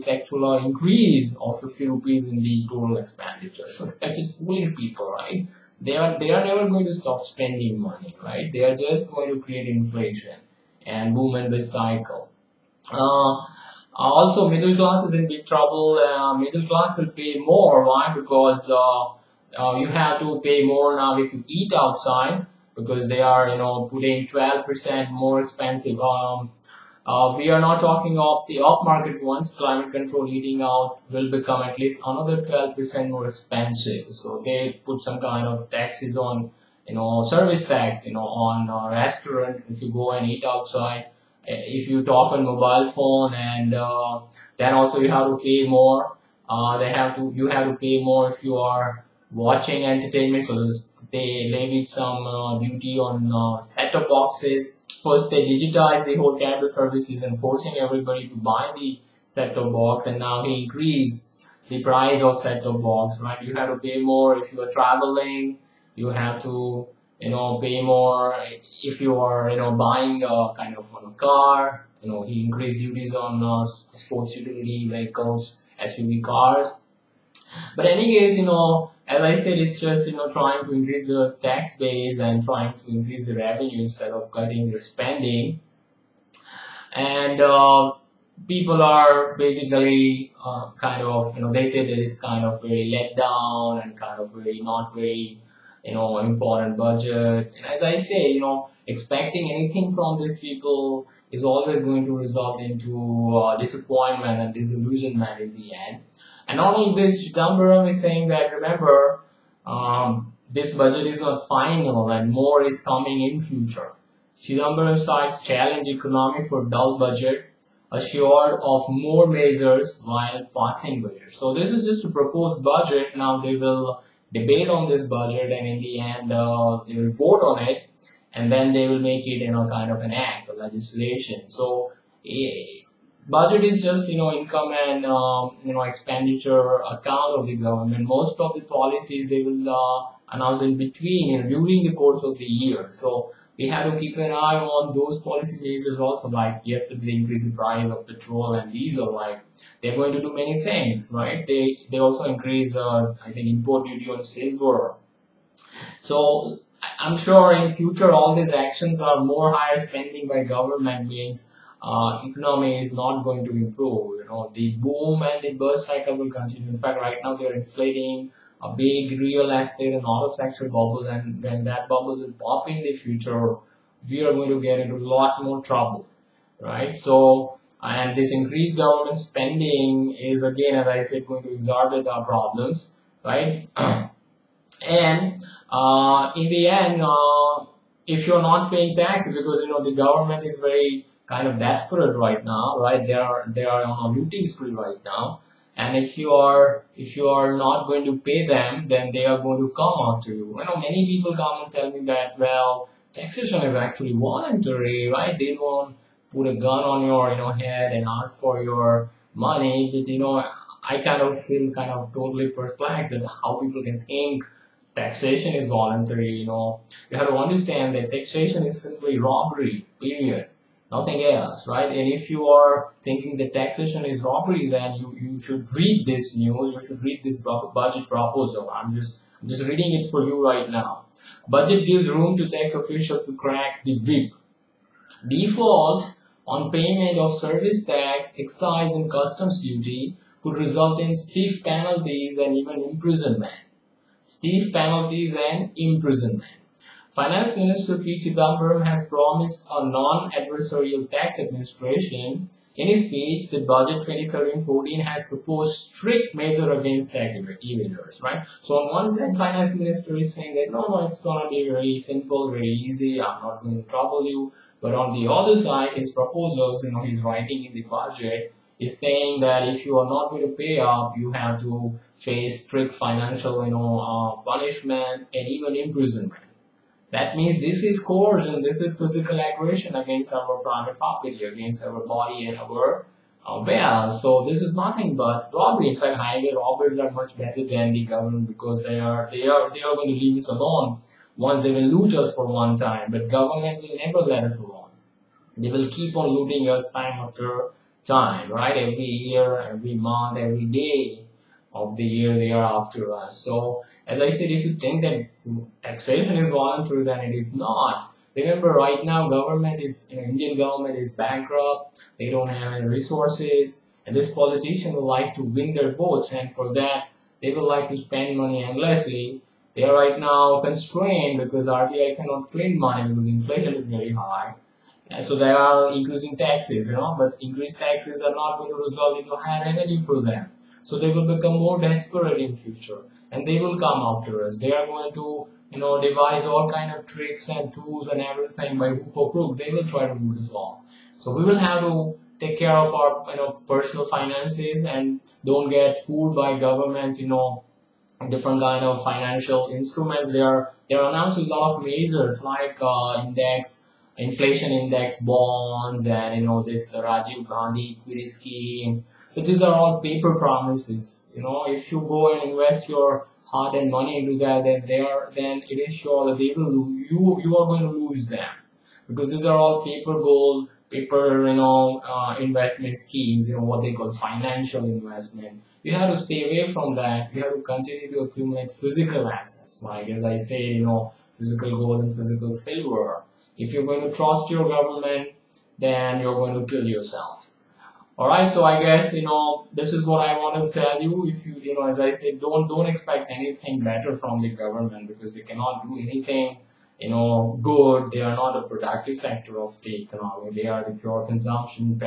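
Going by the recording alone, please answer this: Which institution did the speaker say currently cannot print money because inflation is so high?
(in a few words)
RBI.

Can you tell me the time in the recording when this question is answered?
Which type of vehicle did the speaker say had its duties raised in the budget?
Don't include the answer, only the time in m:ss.
1:13.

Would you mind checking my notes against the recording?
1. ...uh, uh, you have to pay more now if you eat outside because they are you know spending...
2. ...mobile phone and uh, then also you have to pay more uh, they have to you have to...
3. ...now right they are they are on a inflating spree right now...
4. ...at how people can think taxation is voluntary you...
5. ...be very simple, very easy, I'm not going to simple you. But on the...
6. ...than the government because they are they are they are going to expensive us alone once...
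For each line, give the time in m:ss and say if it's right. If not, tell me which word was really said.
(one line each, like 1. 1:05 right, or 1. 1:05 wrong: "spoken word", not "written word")
1. 0:18 wrong: "putting", not "spending"
2. 0:42 right
3. 3:12 wrong: "looting", not "inflating"
4. 3:33 right
5. 4:21 wrong: "trouble", not "simple"
6. 4:47 wrong: "leave", not "expensive".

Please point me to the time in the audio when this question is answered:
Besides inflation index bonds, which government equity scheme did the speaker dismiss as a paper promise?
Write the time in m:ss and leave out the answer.
5:56.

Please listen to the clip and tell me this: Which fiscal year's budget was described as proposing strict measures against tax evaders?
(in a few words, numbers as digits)
2013-14.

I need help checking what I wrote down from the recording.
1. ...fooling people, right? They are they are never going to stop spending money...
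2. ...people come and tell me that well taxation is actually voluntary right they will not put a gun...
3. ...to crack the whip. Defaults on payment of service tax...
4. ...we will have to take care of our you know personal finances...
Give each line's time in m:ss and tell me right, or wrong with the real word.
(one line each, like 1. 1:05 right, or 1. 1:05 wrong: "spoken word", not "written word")
1. 0:04 right
2. 3:21 right
3. 3:53 right
4. 5:41 right.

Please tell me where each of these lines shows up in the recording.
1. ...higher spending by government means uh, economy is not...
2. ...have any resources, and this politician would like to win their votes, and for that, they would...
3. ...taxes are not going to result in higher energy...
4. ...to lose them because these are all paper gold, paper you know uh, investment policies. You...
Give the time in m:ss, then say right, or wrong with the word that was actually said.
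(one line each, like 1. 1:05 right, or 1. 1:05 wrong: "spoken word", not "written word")
1. 2:39 right
2. 5:12 right
3. 5:27 right
4. 6:07 wrong: "schemes", not "policies".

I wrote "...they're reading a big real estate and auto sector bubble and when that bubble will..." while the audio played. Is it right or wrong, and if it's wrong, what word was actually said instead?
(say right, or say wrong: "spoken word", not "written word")
wrong: "inflating", not "reading".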